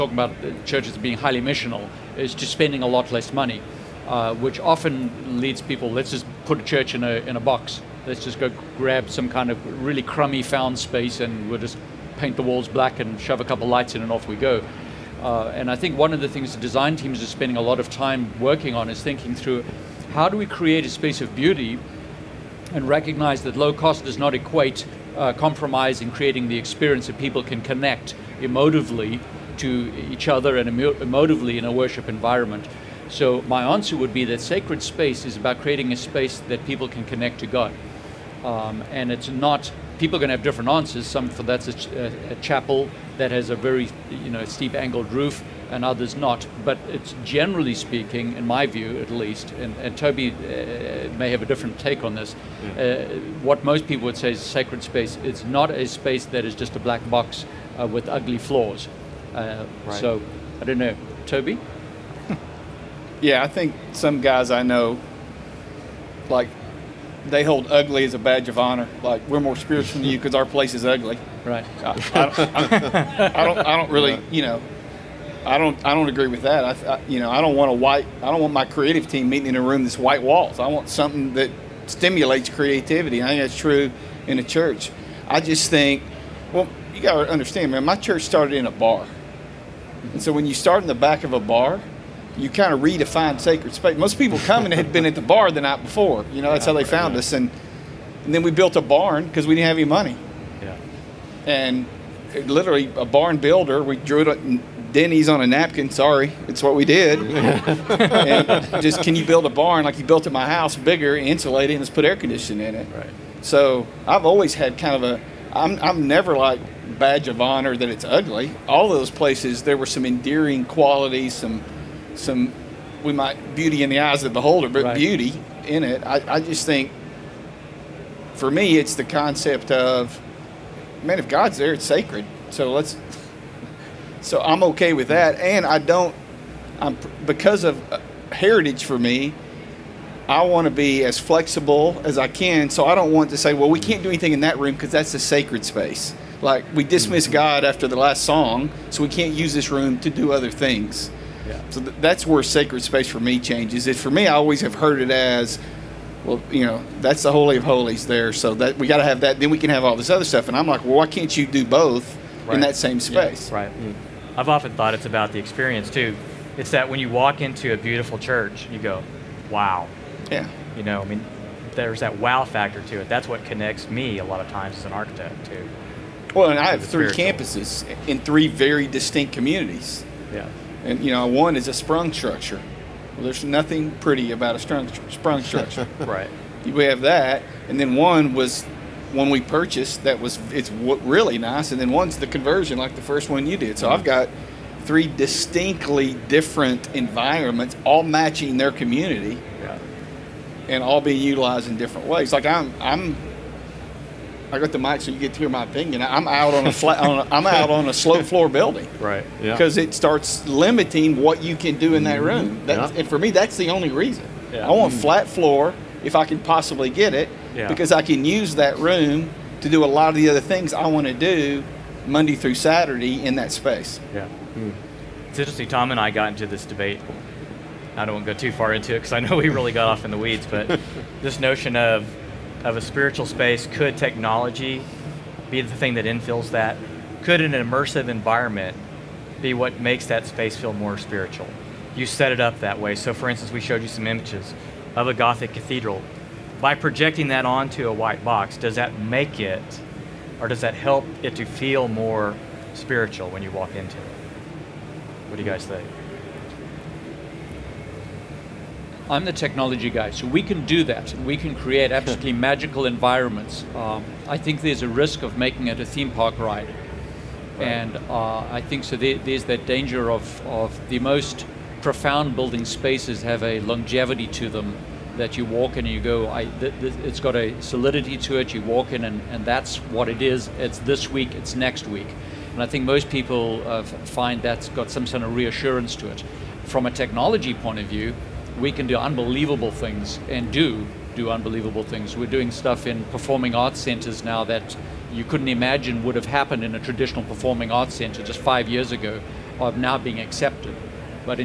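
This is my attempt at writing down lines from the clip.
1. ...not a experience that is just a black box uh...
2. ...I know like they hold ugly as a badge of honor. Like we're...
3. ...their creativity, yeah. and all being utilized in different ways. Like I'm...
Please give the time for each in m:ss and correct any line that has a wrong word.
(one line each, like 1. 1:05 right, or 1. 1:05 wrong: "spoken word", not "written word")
1. 0:55 wrong: "space", not "experience"
2. 1:04 right
3. 3:18 wrong: "community", not "creativity".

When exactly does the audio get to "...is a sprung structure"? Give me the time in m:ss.
3:01.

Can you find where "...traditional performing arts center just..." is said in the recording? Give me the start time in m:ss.
4:56.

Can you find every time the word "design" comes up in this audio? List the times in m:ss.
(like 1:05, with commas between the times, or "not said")
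0:16.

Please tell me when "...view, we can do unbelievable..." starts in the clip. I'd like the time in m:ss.
4:47.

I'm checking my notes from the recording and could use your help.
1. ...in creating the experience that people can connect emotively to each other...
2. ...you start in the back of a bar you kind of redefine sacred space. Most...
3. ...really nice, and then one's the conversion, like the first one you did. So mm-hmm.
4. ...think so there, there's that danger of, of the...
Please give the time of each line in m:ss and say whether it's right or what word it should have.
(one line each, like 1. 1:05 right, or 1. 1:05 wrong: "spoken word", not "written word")
1. 0:25 right
2. 1:30 right
3. 3:10 right
4. 4:28 right.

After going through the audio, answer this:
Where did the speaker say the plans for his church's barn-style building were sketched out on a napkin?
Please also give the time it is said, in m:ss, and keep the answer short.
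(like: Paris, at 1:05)
Denny's, at 1:44.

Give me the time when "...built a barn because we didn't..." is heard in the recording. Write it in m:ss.
1:38.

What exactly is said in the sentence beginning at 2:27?
God after the last song, so we can't use this room to do other things.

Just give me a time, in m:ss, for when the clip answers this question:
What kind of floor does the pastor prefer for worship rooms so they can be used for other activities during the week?
3:35.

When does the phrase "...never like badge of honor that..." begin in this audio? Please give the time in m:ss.
1:56.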